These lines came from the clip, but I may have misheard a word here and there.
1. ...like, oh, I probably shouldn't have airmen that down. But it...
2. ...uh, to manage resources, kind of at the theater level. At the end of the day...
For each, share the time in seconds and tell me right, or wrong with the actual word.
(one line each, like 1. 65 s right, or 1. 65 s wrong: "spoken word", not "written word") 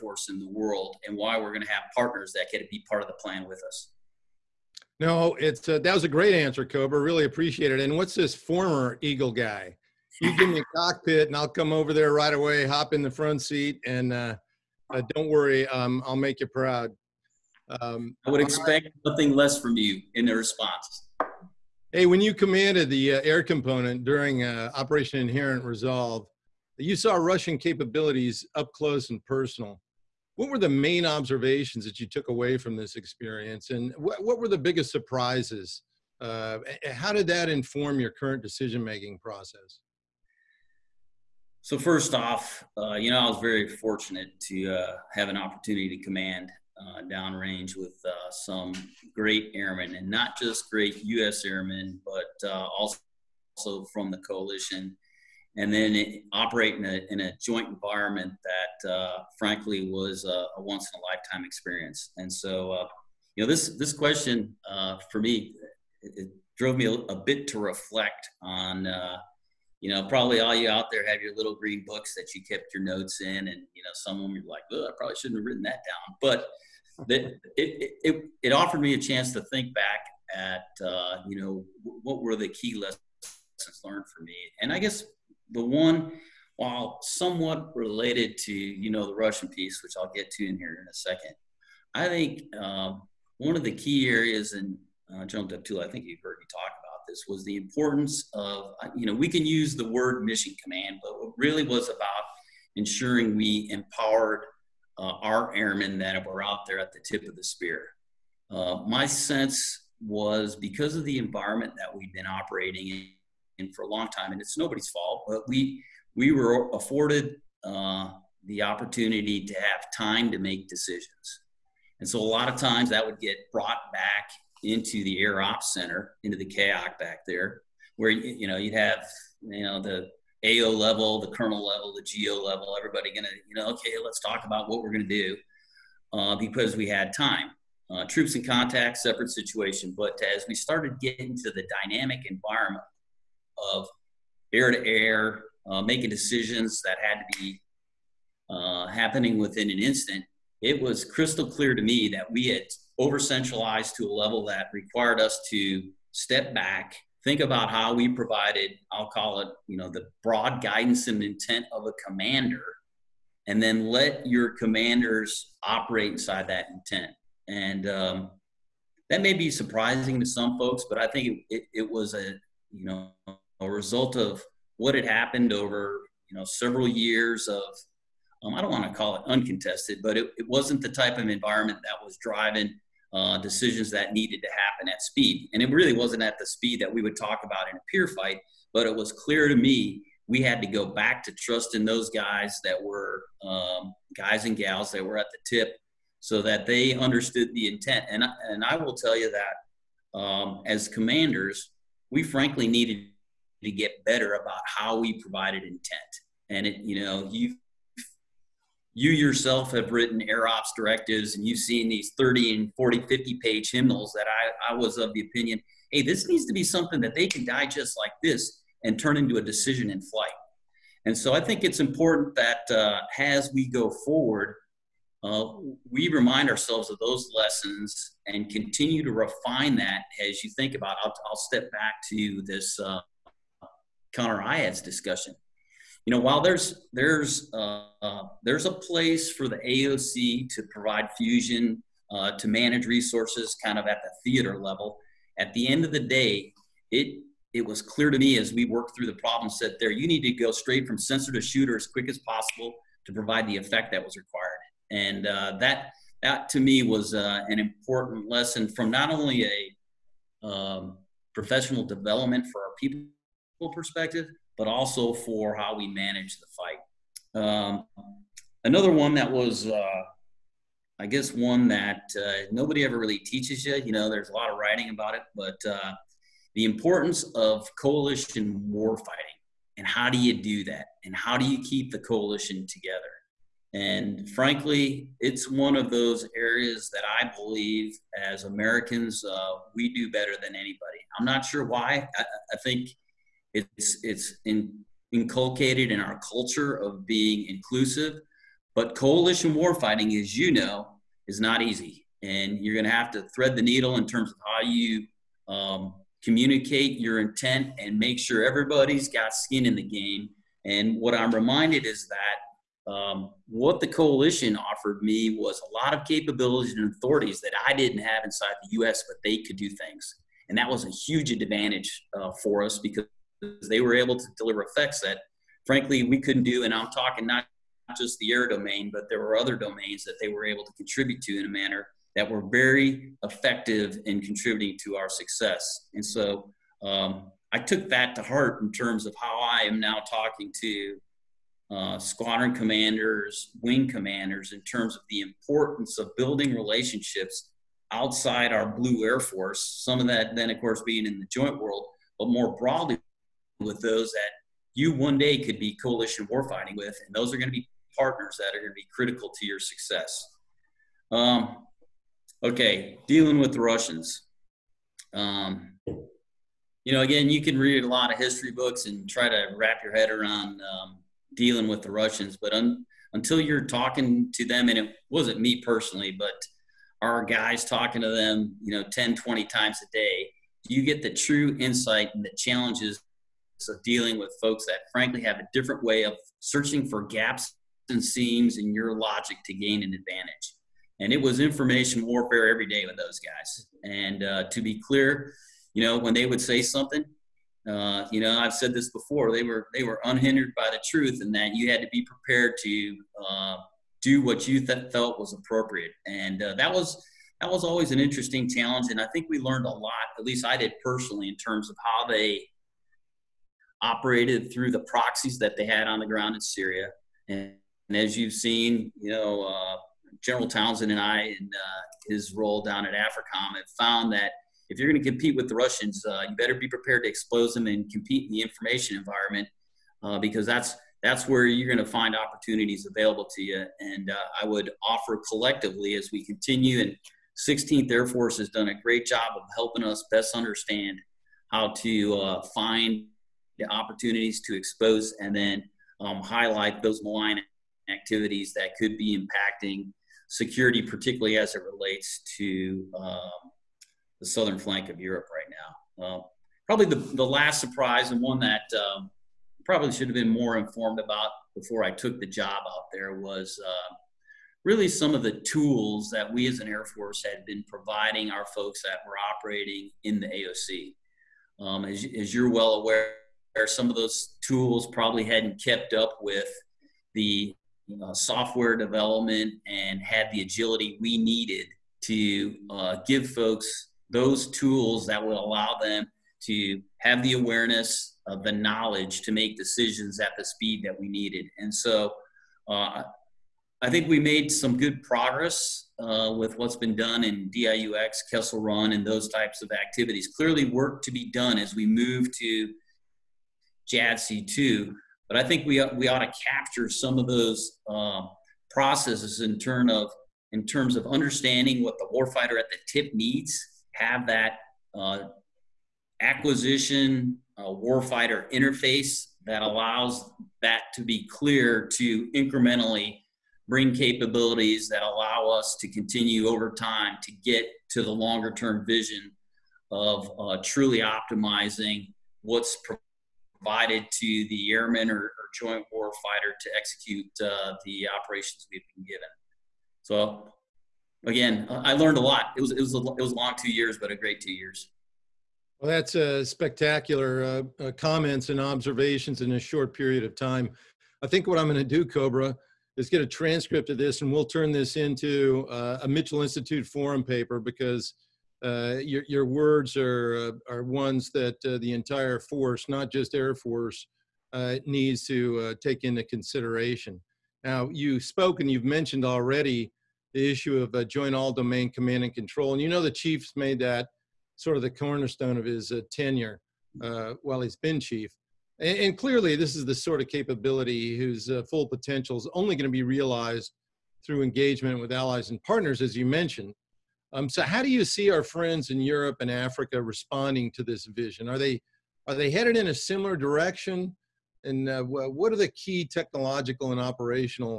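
1. 74 s wrong: "written", not "airmen"
2. 242 s right.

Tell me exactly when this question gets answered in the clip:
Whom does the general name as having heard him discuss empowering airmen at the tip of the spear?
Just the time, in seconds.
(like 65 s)
95 s.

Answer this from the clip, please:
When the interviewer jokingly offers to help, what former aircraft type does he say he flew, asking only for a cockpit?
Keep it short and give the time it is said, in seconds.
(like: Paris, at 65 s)
Eagle, at 9 s.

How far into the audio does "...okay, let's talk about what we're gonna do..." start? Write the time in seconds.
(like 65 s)
133 s.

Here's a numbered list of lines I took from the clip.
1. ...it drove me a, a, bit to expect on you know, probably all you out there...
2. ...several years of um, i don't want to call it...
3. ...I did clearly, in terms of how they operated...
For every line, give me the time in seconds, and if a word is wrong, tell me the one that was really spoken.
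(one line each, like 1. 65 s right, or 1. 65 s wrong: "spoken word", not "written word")
1. 66 s wrong: "reflect", not "expect"
2. 176 s right
3. 410 s wrong: "personally", not "clearly".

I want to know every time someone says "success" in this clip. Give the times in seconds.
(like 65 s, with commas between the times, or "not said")
335 s, 359 s.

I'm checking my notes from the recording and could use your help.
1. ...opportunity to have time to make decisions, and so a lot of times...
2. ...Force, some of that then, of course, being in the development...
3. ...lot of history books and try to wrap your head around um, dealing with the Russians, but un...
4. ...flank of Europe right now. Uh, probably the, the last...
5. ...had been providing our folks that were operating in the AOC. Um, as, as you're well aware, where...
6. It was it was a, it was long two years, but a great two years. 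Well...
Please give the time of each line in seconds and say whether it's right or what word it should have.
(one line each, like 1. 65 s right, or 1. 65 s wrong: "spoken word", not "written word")
1. 118 s right
2. 349 s wrong: "joint", not "development"
3. 367 s right
4. 454 s right
5. 467 s right
6. 542 s right.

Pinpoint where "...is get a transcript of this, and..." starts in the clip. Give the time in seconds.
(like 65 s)
552 s.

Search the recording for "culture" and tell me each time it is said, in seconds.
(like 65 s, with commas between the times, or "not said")
296 s.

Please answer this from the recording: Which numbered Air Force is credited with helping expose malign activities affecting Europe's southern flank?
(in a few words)
16th Air Force.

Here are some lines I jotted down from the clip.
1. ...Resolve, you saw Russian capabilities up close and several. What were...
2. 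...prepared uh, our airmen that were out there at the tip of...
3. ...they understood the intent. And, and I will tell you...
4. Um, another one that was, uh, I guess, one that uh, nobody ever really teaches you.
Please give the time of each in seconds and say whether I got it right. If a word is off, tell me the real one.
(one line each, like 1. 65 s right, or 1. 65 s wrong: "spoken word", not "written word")
1. 25 s wrong: "personal", not "several"
2. 103 s wrong: "empowered", not "prepared"
3. 196 s right
4. 267 s right.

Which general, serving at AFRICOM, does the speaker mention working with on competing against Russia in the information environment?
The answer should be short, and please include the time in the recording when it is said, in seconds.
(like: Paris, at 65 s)
General Townsend, at 420 s.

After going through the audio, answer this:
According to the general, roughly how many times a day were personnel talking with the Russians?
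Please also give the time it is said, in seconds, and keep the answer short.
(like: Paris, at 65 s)
10, 20 times, at 378 s.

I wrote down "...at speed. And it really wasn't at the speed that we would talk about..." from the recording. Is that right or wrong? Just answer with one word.
right.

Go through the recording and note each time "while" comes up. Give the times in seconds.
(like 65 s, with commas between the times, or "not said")
86 s, 236 s, 577 s.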